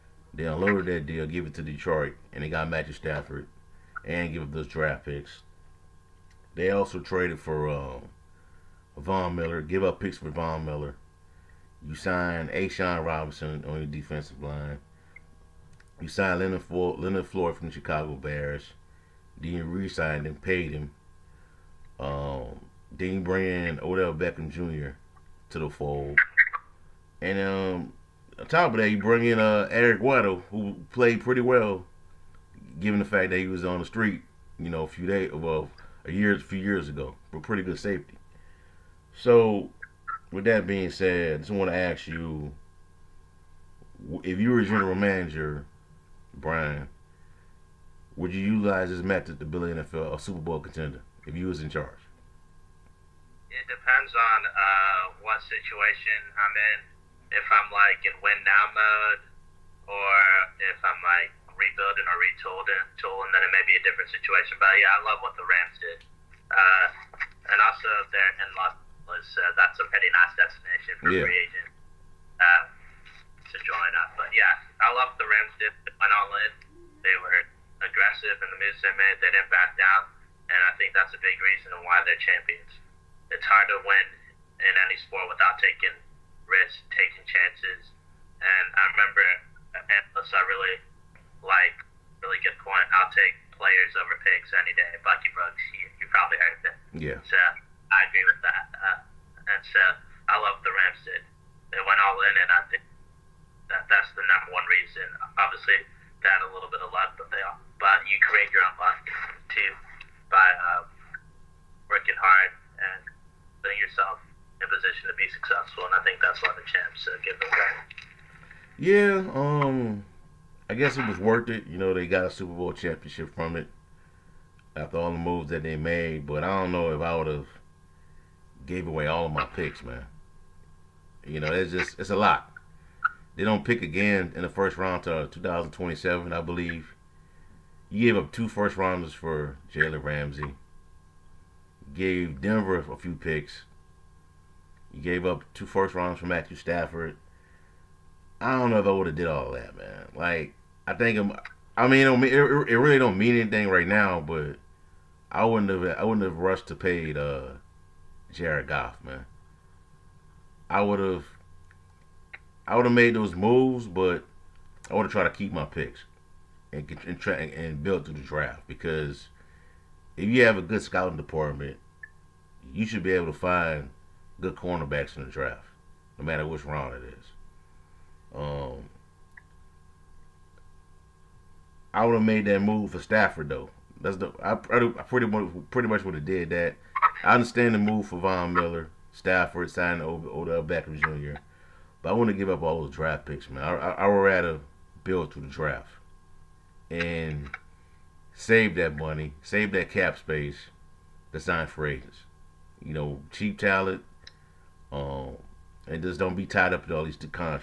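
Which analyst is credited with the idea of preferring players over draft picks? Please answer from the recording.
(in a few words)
Bucky Brooks.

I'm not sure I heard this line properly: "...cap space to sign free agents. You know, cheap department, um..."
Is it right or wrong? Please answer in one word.
wrong.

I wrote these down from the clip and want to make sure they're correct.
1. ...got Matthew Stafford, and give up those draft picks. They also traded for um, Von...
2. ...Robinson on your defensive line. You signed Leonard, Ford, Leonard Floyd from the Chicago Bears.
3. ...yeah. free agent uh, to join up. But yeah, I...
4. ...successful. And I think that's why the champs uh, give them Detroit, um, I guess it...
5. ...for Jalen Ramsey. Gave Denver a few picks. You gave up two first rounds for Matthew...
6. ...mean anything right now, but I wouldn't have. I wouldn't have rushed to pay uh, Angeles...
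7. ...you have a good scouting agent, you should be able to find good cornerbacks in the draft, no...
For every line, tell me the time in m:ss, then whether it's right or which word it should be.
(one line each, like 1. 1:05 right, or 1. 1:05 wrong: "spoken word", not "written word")
1. 0:02 right
2. 0:13 right
3. 1:11 right
4. 1:55 wrong: "Yeah", not "Detroit"
5. 2:19 right
6. 2:33 wrong: "Jared", not "Angeles"
7. 2:50 wrong: "department", not "agent".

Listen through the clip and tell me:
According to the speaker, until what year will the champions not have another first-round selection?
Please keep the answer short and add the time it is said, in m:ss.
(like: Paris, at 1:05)
2027, at 2:15.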